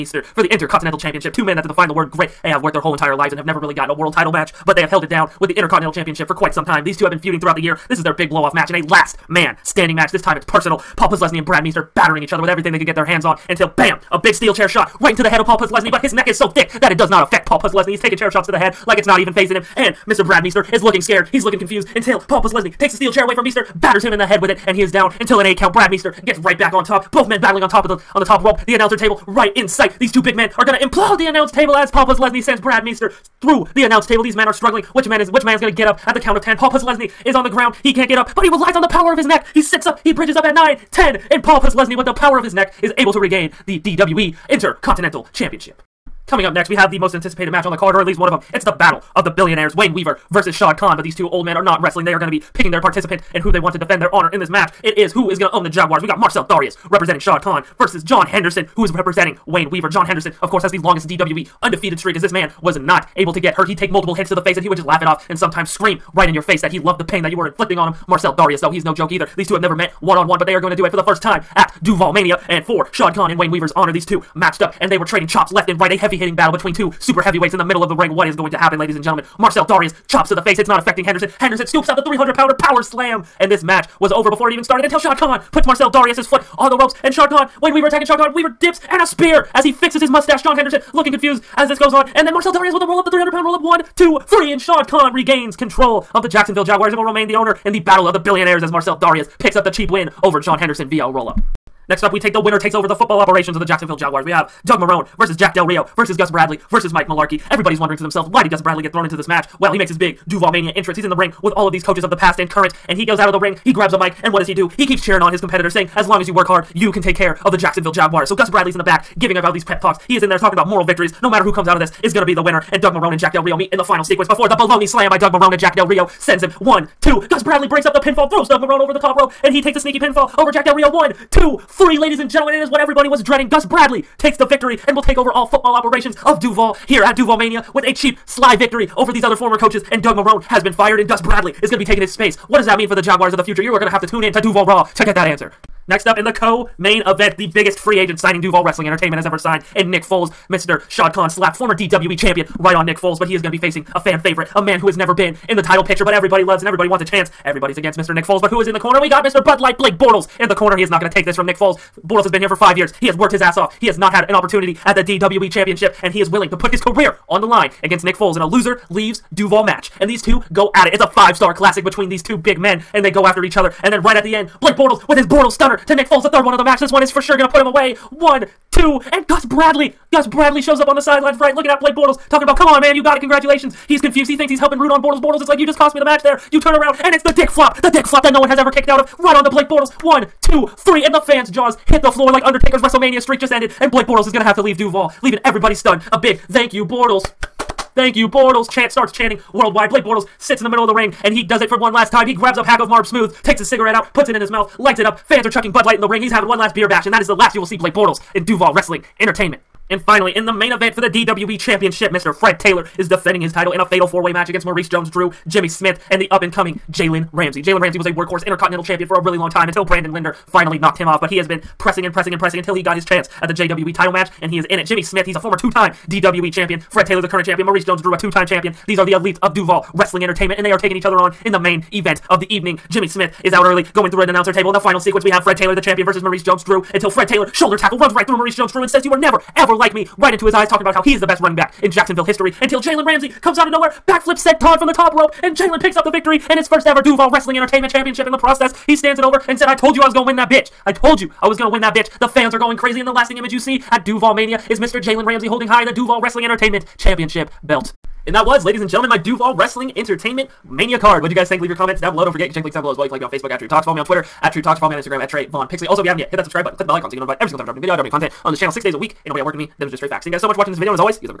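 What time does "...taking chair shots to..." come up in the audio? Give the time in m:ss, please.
0:18.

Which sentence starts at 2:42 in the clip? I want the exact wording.
Bortles has been here for five years.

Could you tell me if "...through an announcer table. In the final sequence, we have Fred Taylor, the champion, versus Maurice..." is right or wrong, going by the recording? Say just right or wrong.
right.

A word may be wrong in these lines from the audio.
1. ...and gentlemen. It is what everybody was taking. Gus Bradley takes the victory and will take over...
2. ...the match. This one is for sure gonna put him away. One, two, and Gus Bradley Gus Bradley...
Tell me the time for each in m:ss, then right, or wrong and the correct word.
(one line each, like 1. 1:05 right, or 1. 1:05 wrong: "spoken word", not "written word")
1. 2:12 wrong: "dreading", not "taking"
2. 2:56 right.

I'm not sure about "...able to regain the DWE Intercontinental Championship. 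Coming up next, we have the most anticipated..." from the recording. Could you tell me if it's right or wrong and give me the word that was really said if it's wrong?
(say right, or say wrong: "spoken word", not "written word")
right.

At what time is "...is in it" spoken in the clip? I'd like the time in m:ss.
3:44.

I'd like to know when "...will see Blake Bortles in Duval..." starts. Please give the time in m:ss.
3:27.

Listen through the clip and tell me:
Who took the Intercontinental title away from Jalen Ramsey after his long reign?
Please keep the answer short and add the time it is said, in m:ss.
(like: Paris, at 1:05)
Brandon Linder, at 3:39.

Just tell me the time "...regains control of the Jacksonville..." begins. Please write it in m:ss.
1:35.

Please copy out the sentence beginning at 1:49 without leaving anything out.
Well, he makes his big Duval Mania entrance.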